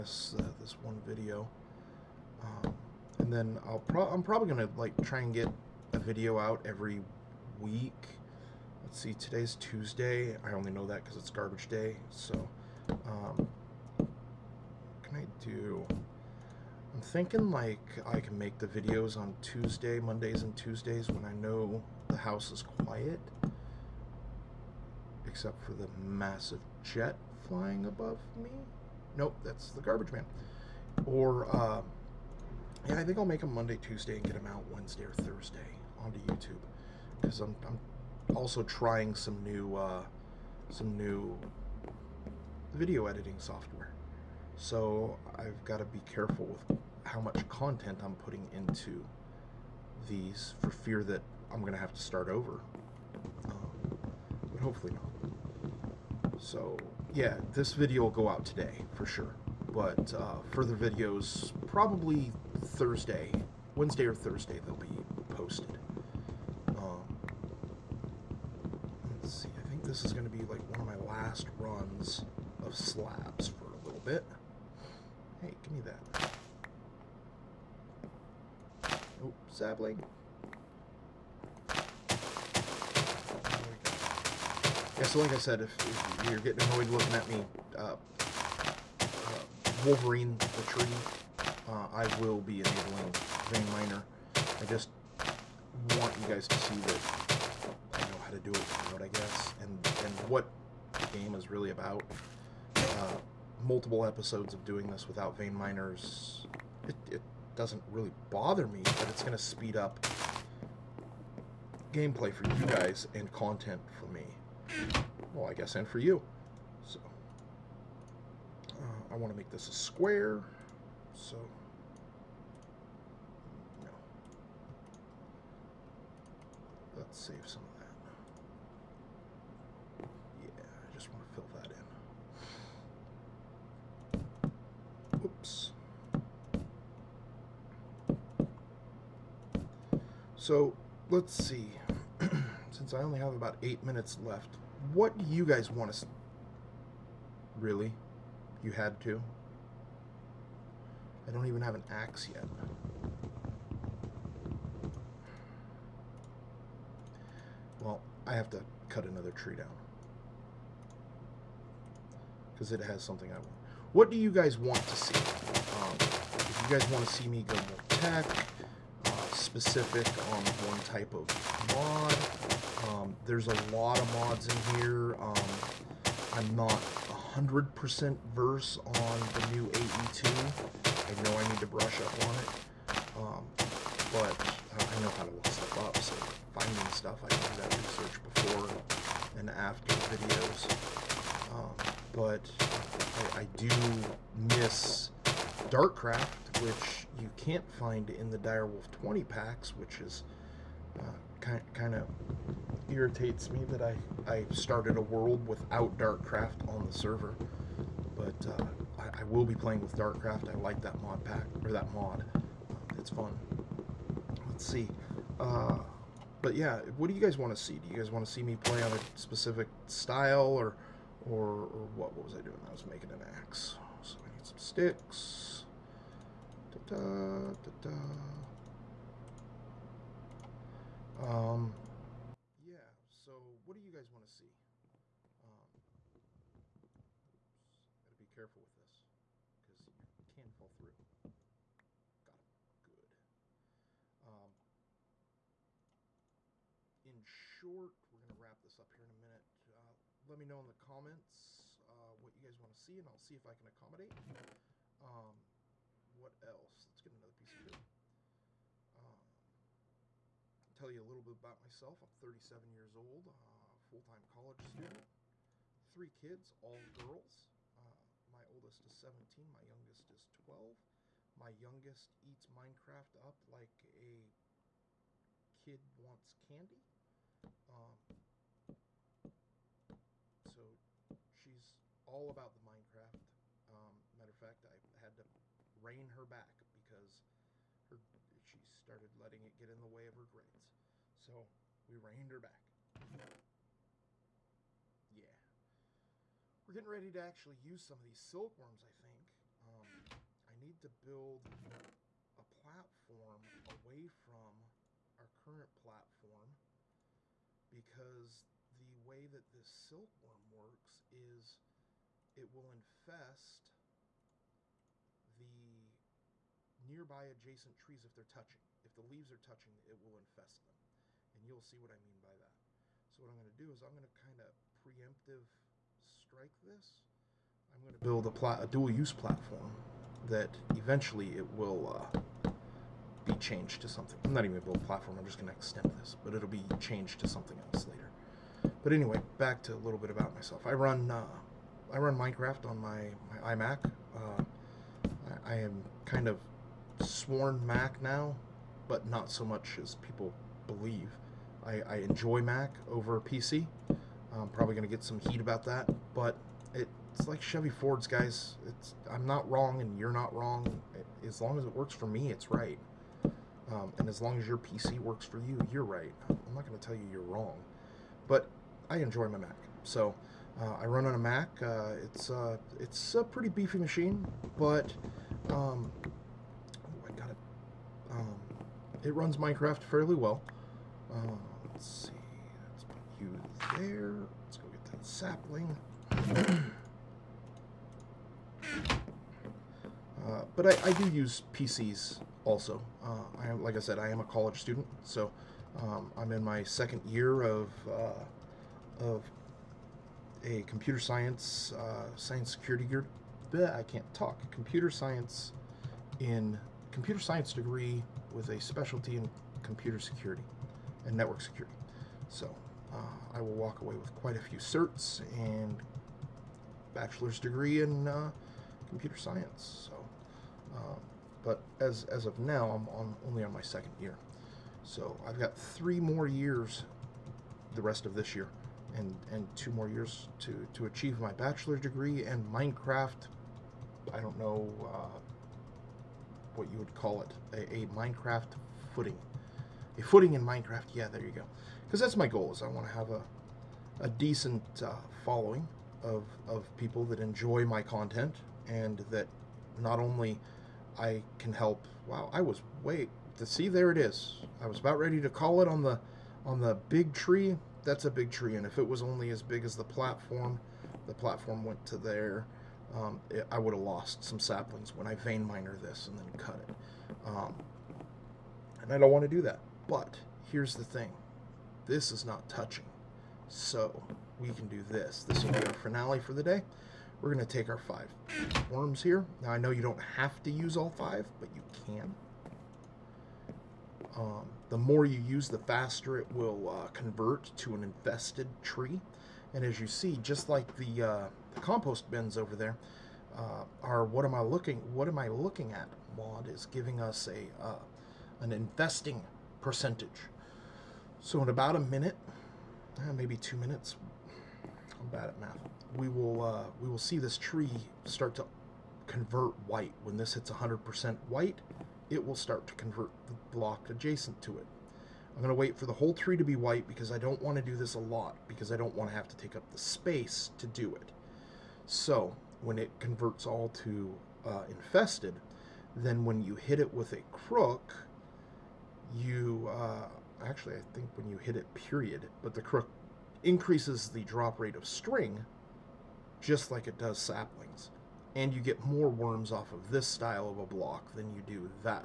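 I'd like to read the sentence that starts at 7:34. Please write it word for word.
I was about ready to call it on the on the big tree.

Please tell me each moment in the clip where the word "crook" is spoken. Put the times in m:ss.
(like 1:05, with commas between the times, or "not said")
8:47, 8:52.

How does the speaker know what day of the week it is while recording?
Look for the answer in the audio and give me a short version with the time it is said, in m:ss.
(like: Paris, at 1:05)
Garbage day, at 0:11.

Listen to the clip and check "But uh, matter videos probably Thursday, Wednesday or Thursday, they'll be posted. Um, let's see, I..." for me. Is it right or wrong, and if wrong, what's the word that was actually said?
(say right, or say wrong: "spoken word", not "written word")
wrong: "further", not "matter".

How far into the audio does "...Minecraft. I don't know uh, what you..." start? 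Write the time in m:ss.
7:12.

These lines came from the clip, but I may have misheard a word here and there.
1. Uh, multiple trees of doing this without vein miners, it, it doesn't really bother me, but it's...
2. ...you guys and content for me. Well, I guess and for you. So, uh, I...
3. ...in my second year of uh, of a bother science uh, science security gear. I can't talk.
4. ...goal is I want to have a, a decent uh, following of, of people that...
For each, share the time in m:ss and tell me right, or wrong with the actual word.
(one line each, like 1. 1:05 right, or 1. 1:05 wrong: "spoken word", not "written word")
1. 1:42 wrong: "episodes", not "trees"
2. 1:52 right
3. 6:36 wrong: "computer", not "bother"
4. 7:22 right.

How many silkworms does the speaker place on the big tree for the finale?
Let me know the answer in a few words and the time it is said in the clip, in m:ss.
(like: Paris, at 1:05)
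5, at 7:57.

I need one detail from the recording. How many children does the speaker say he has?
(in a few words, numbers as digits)
3.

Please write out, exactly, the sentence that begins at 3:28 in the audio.
But uh, I, I will be playing with Dartcraft.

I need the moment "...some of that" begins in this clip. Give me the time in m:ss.
2:07.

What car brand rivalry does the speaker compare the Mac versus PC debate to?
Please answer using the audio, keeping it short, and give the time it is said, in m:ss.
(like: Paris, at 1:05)
Chevy Fords, at 5:57.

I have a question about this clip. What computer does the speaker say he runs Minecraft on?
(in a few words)
iMac.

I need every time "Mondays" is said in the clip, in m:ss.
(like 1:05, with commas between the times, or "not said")
0:19, 0:33.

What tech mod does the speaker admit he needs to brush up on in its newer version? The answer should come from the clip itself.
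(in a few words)
AE2.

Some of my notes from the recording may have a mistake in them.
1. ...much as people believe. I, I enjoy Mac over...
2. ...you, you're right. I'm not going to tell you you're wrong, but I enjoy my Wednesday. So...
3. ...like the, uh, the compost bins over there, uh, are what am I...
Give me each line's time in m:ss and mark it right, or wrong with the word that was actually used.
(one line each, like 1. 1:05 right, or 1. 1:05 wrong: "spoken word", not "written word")
1. 5:49 right
2. 6:05 wrong: "Mac", not "Wednesday"
3. 8:10 right.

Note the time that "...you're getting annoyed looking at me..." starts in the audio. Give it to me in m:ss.
1:26.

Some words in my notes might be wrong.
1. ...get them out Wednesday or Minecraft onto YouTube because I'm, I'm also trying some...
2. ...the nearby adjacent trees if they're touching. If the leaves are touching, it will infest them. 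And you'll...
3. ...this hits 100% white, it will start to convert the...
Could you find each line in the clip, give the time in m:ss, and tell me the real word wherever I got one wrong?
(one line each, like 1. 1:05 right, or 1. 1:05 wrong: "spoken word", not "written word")
1. 0:34 wrong: "Thursday", not "Minecraft"
2. 5:15 right
3. 8:30 right.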